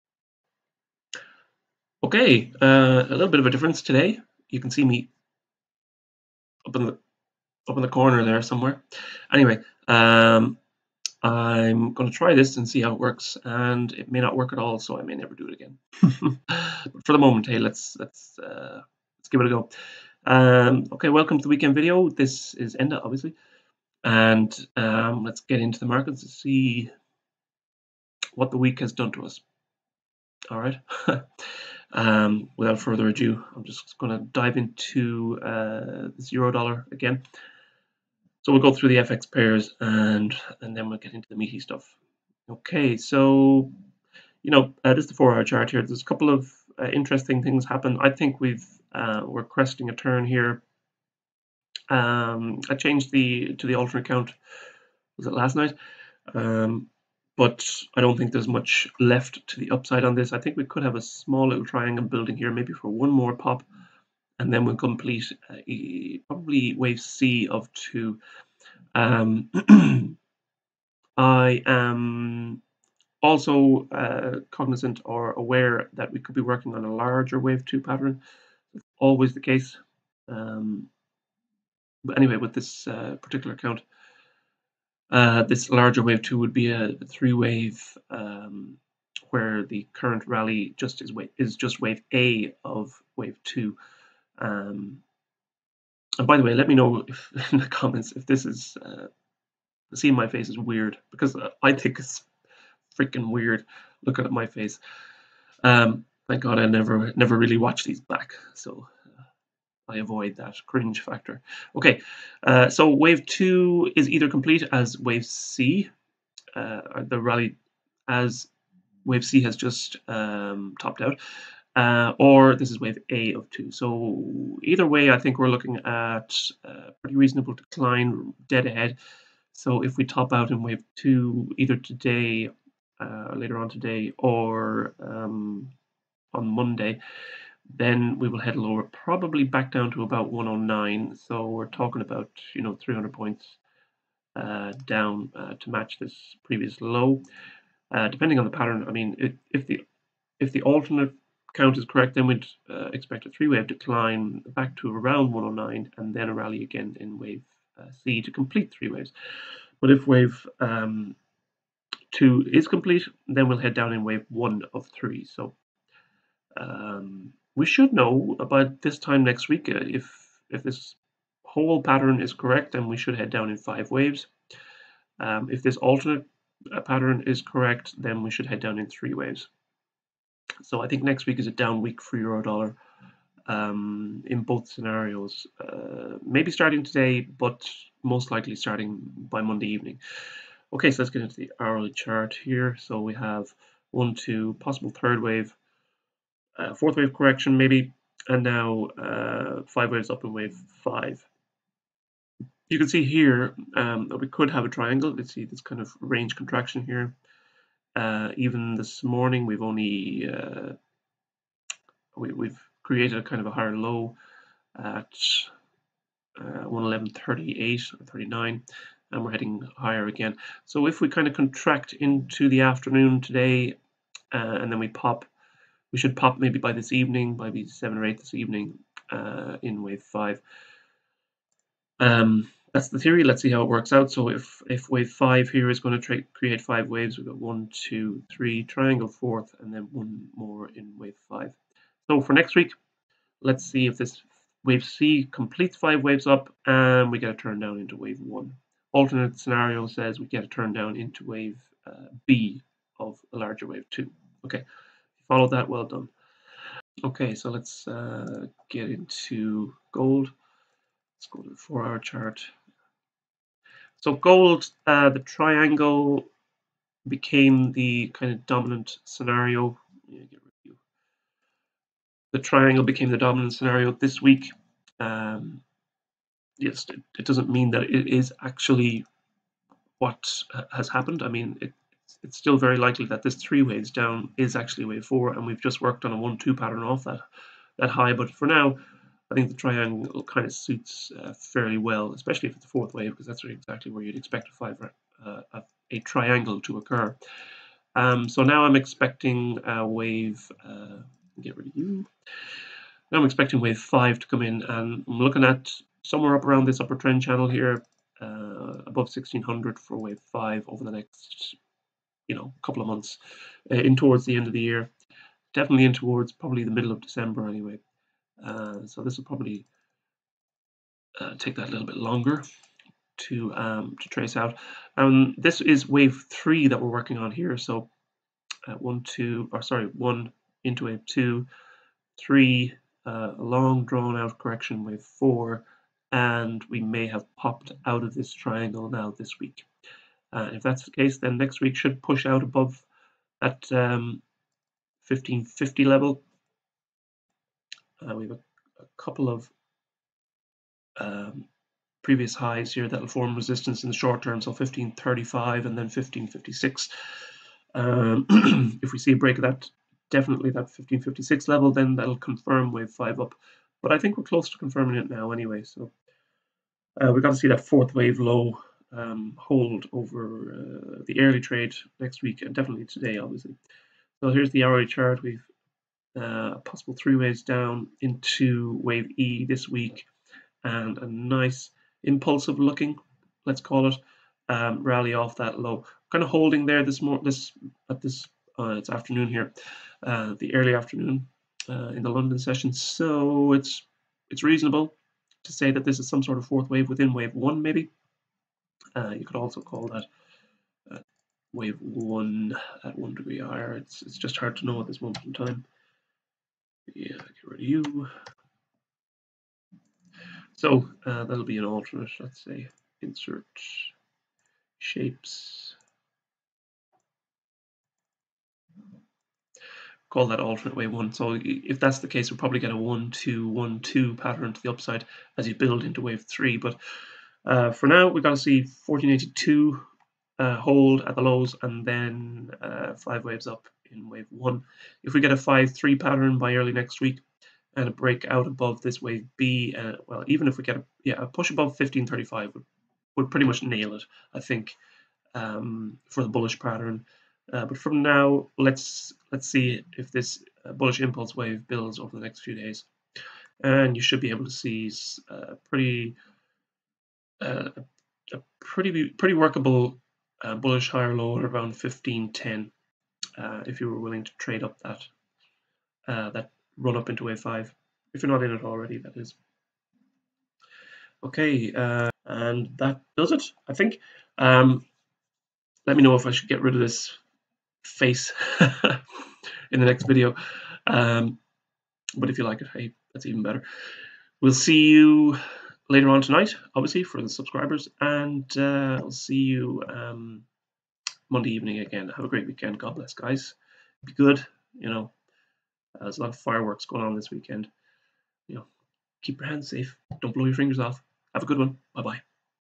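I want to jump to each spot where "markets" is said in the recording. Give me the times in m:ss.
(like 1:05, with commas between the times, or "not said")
0:25.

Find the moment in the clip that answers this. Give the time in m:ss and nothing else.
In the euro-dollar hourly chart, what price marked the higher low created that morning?
3:36.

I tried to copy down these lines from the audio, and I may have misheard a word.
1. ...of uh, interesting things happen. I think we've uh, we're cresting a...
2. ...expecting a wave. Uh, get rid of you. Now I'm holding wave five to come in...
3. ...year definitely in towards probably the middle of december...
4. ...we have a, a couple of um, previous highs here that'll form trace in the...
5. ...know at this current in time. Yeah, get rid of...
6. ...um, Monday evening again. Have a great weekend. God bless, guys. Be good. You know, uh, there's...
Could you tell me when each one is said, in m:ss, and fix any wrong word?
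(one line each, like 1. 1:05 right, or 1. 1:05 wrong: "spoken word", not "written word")
1. 0:46 right
2. 4:58 wrong: "expecting", not "holding"
3. 5:14 right
4. 5:48 wrong: "resistance", not "trace"
5. 6:44 wrong: "moment", not "current"
6. 8:09 right.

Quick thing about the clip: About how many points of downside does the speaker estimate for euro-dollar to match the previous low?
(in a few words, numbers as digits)
300.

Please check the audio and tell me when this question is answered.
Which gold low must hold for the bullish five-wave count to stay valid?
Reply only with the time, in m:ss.
7:08.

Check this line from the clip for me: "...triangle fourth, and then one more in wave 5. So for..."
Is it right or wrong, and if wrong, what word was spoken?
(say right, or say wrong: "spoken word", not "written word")
right.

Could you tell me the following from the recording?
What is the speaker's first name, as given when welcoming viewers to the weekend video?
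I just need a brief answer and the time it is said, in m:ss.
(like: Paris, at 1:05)
Enda, at 0:22.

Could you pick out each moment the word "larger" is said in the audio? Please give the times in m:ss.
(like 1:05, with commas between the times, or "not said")
1:16, 1:25, 4:13.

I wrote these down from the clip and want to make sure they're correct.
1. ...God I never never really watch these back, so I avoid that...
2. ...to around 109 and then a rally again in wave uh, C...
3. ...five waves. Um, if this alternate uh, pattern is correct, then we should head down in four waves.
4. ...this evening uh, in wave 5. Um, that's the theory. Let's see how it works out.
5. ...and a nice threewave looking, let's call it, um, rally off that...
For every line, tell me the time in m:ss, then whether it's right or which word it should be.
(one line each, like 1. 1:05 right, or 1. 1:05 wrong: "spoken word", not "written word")
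1. 1:46 right
2. 2:34 right
3. 2:53 wrong: "three", not "four"
4. 3:48 right
5. 6:20 wrong: "impulsive", not "threewave".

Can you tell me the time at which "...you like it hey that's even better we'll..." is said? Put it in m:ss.
8:02.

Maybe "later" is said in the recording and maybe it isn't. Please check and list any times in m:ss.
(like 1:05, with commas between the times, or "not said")
2:13, 8:05.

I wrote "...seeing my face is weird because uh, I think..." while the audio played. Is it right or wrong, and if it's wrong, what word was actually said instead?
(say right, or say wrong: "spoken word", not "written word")
right.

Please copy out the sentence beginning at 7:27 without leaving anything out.
Uh, but from now, let's let's see if this uh, bullish impulse wave builds over the next few days.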